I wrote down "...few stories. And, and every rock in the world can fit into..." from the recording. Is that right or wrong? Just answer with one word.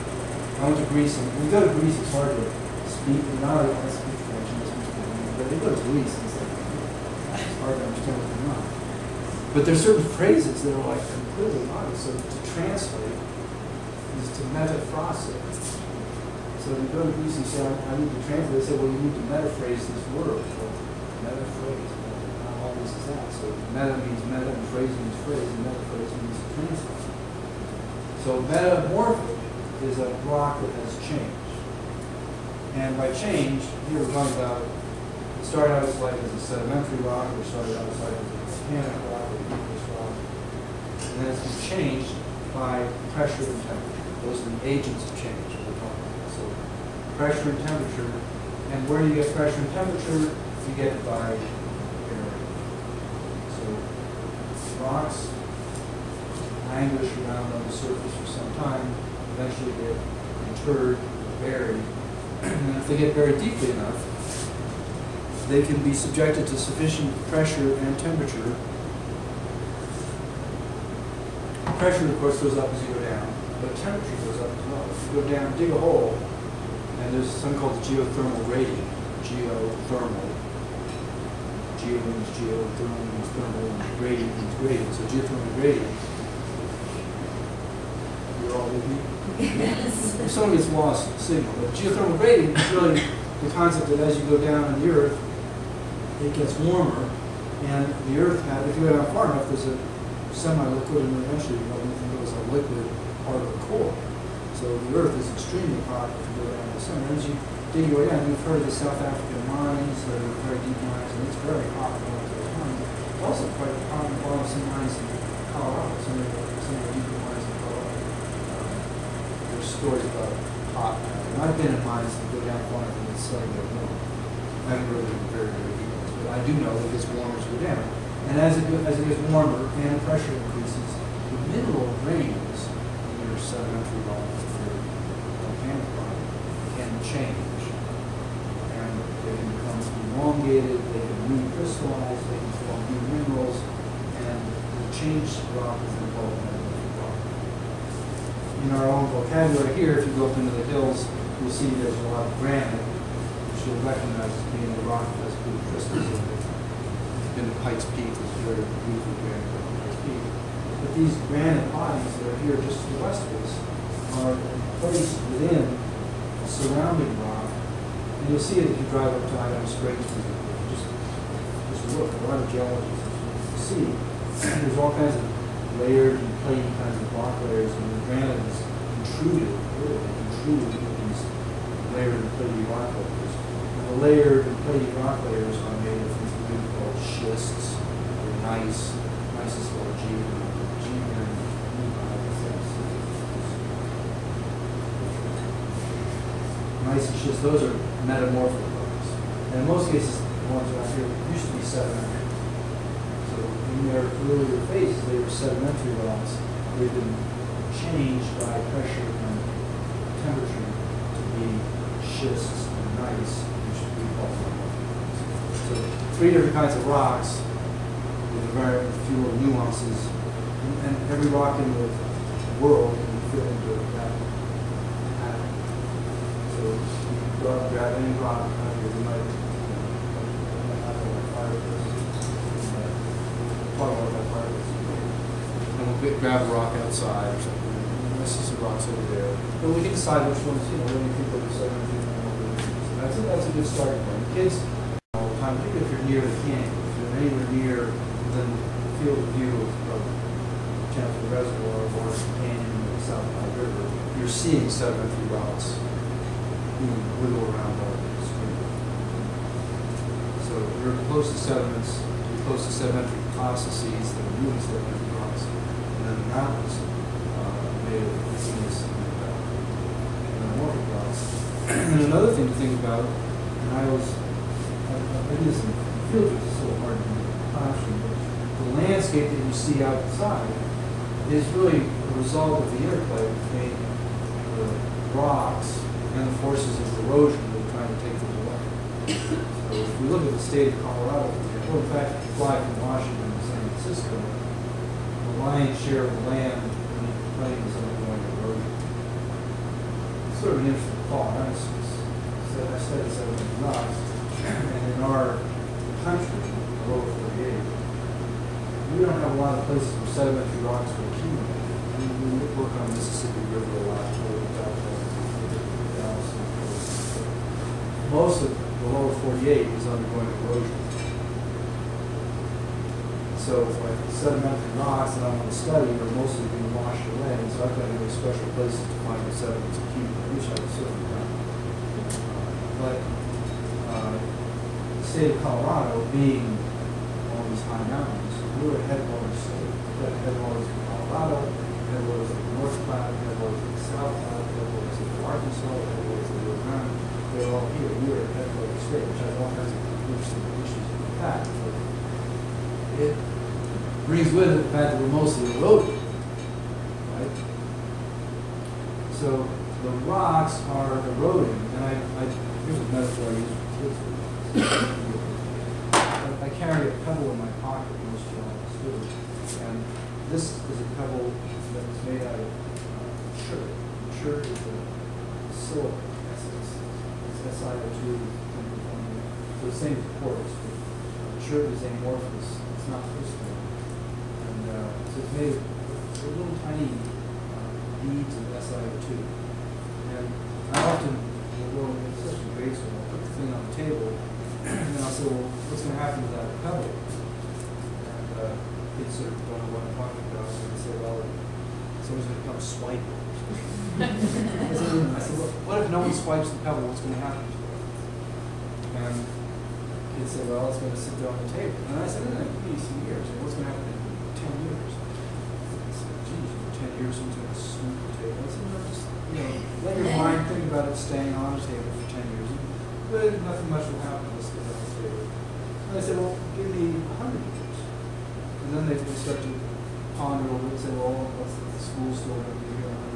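wrong.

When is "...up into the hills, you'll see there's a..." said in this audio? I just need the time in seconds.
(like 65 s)
150 s.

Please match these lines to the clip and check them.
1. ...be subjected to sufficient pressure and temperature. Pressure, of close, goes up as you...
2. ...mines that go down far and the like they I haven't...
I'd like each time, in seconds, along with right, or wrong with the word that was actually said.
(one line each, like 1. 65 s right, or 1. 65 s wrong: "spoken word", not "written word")
1. 65 s wrong: "course", not "close"
2. 121 s right.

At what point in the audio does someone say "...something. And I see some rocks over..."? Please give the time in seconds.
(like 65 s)
237 s.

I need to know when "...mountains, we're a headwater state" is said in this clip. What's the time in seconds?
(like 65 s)
337 s.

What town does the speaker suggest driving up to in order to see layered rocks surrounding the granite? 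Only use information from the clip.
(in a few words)
Idaho Springs.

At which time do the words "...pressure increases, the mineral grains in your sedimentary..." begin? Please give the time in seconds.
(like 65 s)
130 s.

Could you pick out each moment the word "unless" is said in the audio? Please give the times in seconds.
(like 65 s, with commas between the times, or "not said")
424 s.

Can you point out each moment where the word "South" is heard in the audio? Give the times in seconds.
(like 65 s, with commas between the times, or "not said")
108 s, 253 s, 343 s.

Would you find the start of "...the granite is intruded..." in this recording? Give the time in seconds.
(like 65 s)
177 s.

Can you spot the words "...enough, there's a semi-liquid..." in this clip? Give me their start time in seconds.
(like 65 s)
99 s.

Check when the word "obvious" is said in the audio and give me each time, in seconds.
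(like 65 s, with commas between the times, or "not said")
11 s, 22 s.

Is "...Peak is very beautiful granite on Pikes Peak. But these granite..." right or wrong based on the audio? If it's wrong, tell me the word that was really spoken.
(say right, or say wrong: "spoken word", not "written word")
right.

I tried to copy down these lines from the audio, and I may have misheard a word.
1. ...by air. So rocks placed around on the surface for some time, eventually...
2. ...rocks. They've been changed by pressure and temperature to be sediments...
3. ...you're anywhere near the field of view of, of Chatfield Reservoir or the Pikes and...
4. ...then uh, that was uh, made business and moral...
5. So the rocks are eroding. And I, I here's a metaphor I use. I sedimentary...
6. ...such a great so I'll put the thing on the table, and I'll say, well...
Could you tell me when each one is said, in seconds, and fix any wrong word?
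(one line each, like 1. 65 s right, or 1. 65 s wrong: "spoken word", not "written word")
1. 51 s wrong: "languished", not "placed"
2. 206 s wrong: "schists", not "sediments"
3. 246 s wrong: "Canyon", not "Pikes"
4. 266 s right
5. 359 s wrong: "carry", not "sedimentary"
6. 392 s right.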